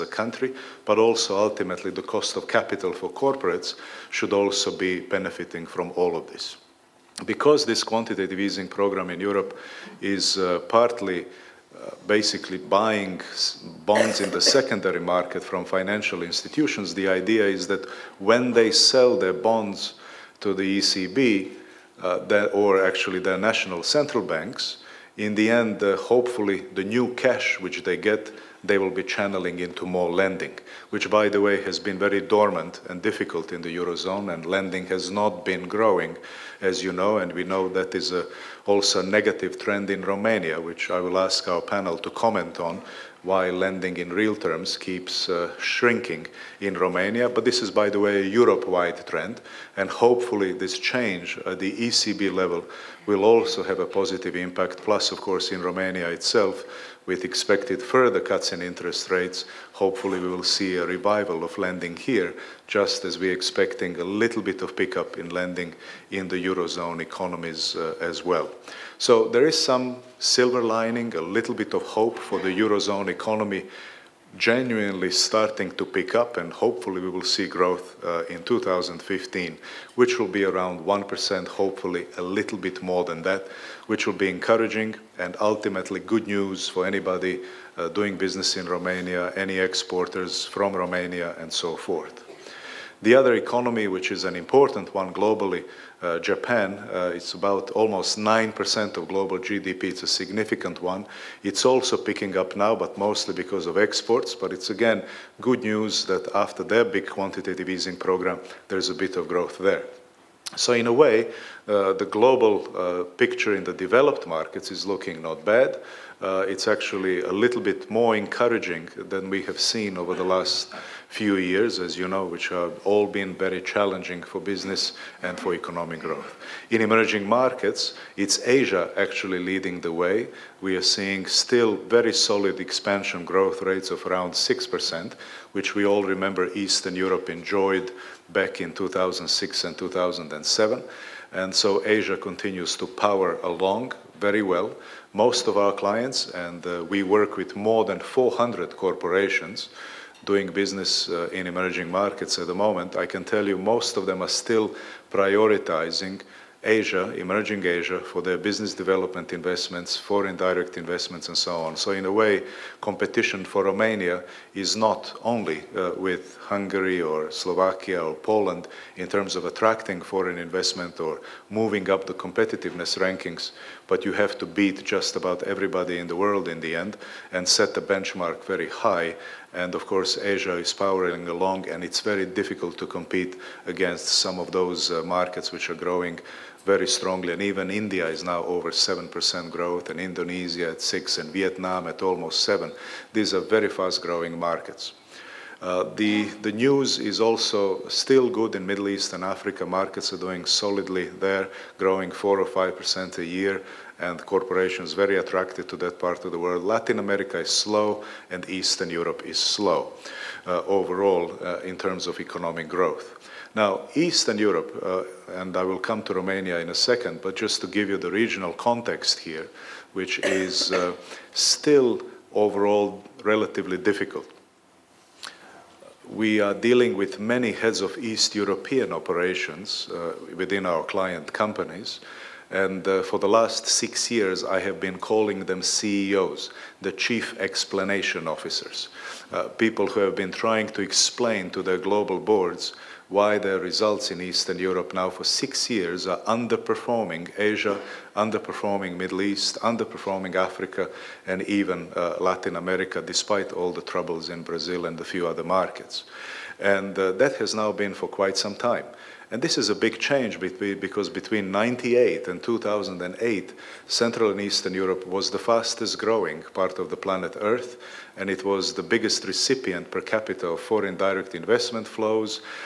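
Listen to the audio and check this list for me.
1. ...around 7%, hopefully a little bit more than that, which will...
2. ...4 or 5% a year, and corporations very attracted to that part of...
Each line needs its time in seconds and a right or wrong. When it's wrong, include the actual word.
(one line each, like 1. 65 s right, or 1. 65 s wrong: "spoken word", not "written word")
1. 80 s wrong: "1", not "7"
2. 202 s right.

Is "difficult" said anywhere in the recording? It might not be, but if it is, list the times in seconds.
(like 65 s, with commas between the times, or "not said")
33 s, 182 s, 223 s.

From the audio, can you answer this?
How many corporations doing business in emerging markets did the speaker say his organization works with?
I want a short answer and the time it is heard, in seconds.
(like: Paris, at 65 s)
more than 400, at 147 s.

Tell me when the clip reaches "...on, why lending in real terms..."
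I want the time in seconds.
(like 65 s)
42 s.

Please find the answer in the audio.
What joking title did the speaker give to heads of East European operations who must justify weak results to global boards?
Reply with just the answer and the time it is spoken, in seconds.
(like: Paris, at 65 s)
chief explanation officers, at 236 s.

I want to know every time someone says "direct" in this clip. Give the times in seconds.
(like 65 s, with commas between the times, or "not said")
160 s, 270 s.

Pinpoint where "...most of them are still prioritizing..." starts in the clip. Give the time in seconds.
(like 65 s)
153 s.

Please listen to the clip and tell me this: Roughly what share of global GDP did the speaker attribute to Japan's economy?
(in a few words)
almost 9%.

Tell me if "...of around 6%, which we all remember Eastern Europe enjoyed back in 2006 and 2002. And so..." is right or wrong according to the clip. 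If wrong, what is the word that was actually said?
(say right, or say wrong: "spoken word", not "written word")
wrong: "2007", not "2002".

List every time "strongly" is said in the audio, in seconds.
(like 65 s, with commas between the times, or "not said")
186 s.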